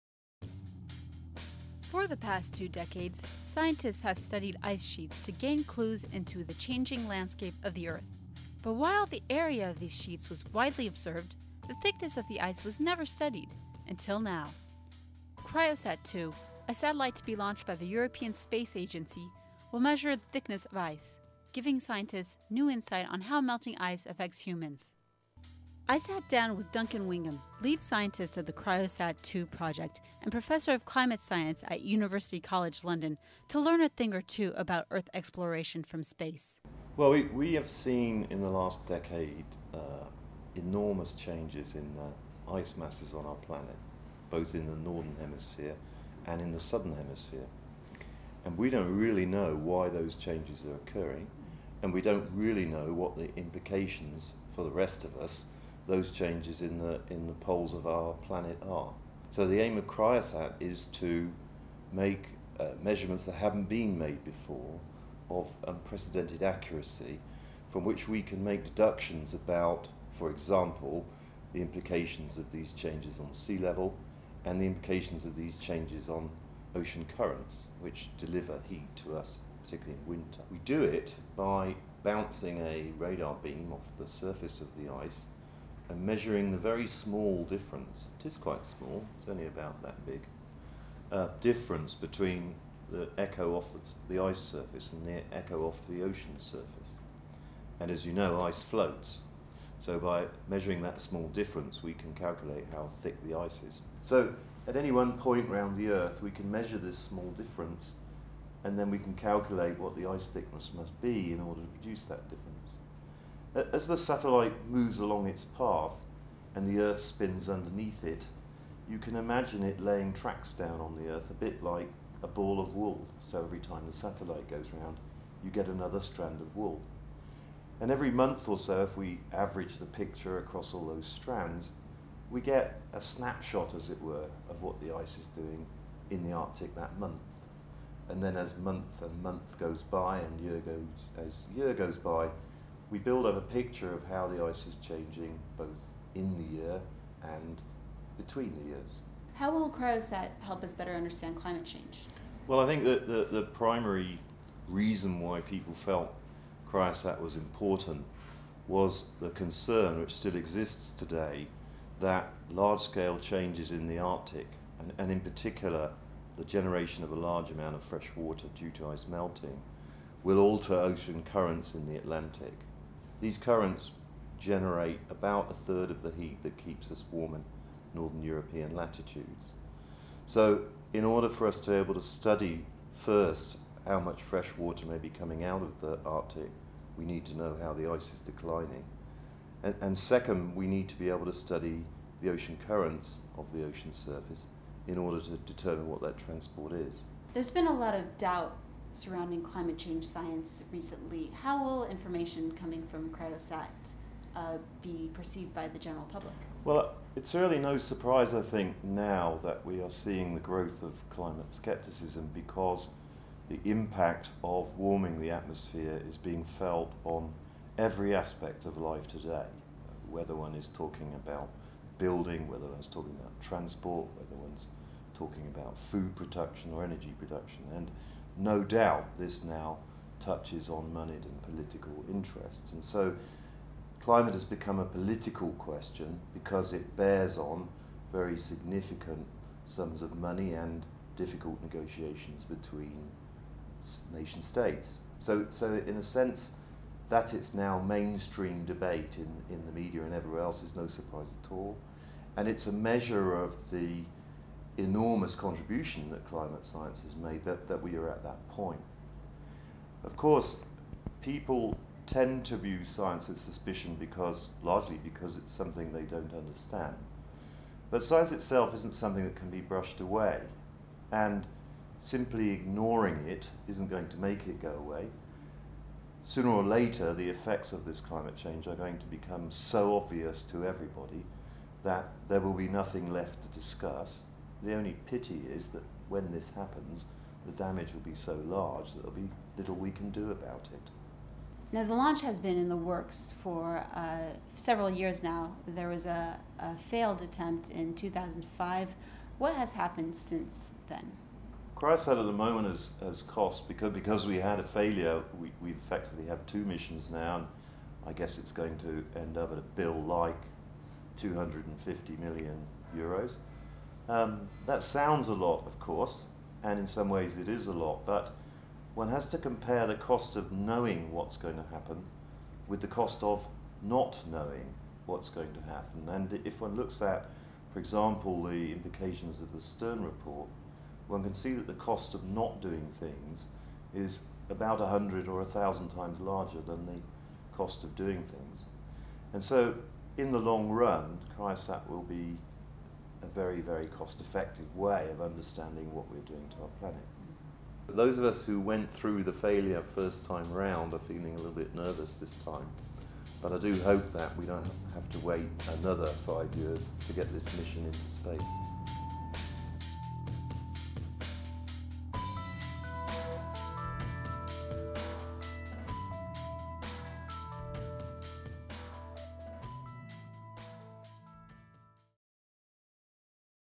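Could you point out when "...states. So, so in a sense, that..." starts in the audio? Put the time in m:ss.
4:04.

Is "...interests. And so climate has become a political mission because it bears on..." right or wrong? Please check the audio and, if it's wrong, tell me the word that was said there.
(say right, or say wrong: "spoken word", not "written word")
wrong: "question", not "mission".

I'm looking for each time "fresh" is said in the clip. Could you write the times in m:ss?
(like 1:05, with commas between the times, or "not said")
2:47, 3:04.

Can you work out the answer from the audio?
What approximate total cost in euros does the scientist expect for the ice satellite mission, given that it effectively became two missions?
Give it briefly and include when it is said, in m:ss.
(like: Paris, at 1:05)
250 million euros, at 5:11.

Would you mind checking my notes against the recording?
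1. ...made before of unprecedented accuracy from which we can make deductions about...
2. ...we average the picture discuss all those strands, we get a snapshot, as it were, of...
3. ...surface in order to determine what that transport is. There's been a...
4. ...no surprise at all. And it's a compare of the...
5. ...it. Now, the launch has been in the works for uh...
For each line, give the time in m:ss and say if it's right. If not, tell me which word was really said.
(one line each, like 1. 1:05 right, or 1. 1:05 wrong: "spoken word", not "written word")
1. 1:03 right
2. 2:08 wrong: "across", not "discuss"
3. 3:13 right
4. 4:10 wrong: "measure", not "compare"
5. 4:50 right.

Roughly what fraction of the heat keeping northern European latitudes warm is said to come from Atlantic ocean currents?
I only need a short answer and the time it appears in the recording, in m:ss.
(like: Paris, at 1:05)
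A third, at 2:55.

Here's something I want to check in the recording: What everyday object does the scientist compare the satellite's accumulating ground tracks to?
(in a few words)
A ball of wool.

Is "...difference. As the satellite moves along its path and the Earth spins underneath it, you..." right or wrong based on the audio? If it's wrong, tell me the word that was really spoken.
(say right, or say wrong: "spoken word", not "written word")
right.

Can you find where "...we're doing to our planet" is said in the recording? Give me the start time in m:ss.
5:46.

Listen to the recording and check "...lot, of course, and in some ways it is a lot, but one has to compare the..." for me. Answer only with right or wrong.
right.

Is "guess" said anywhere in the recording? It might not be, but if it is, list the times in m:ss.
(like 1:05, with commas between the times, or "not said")
5:08.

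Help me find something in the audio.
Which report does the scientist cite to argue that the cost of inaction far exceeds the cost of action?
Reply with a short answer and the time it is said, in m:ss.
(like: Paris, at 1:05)
The Stern report, at 5:29.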